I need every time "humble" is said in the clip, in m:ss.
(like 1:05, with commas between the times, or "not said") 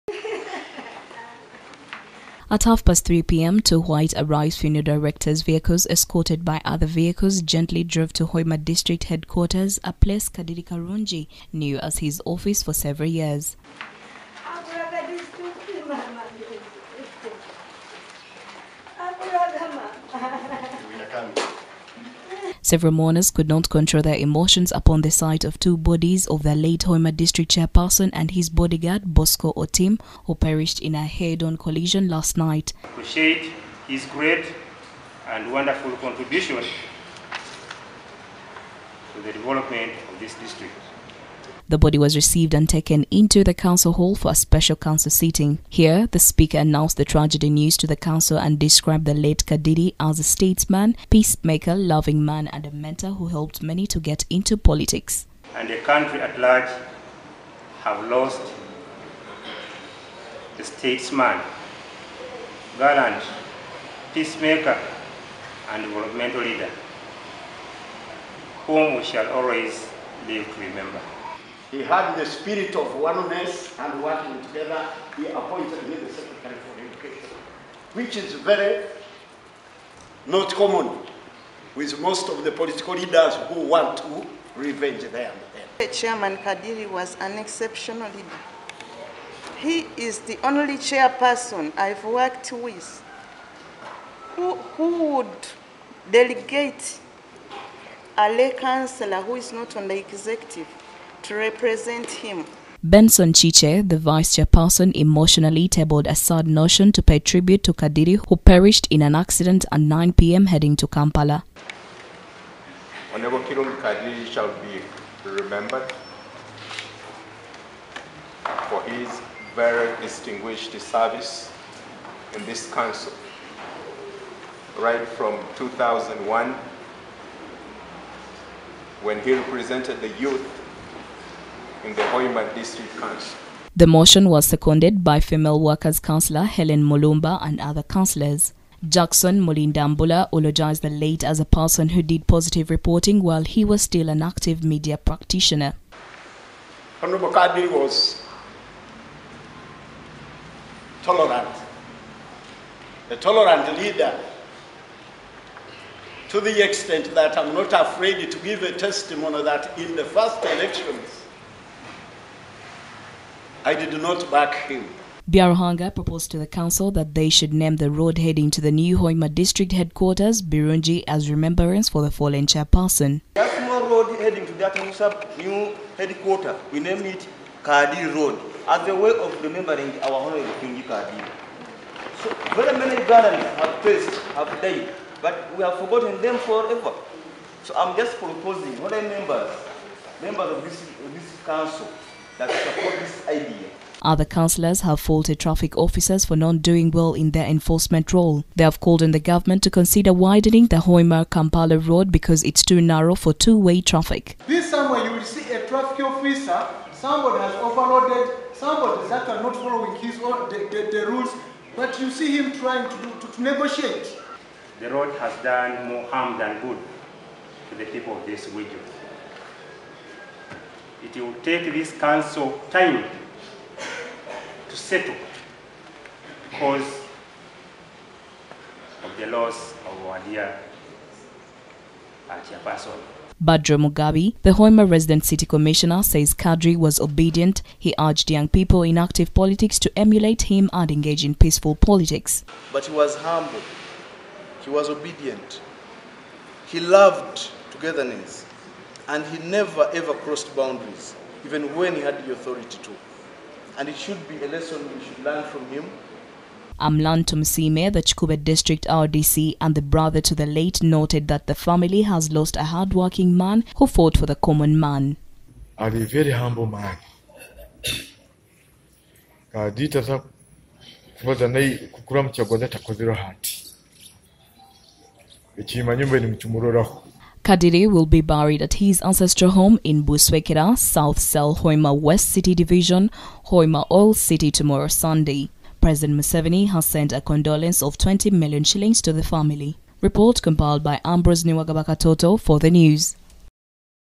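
4:03, 4:26.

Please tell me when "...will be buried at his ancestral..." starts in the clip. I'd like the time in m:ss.
4:37.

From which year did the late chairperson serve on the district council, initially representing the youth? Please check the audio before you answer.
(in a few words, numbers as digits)
2001.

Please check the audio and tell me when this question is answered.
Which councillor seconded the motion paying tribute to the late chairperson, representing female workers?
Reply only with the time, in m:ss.
2:16.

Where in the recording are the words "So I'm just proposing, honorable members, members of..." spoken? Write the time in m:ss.
3:07.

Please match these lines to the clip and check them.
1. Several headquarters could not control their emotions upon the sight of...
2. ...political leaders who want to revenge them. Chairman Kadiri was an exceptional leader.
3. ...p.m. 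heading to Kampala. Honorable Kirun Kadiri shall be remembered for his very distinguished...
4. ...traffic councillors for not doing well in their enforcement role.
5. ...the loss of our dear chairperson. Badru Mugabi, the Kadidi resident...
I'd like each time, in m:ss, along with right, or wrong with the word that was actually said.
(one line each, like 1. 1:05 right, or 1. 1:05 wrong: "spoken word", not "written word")
1. 0:22 wrong: "mourners", not "headquarters"
2. 1:22 right
3. 1:50 right
4. 3:15 wrong: "officers", not "councillors"
5. 3:49 wrong: "Hoima", not "Kadidi".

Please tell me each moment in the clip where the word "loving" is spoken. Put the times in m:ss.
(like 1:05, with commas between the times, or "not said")
0:51.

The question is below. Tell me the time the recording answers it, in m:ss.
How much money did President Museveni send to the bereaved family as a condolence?
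4:47.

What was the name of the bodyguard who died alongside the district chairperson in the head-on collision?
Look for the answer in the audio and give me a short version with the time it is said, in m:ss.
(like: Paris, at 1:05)
Bosco Otim, at 0:29.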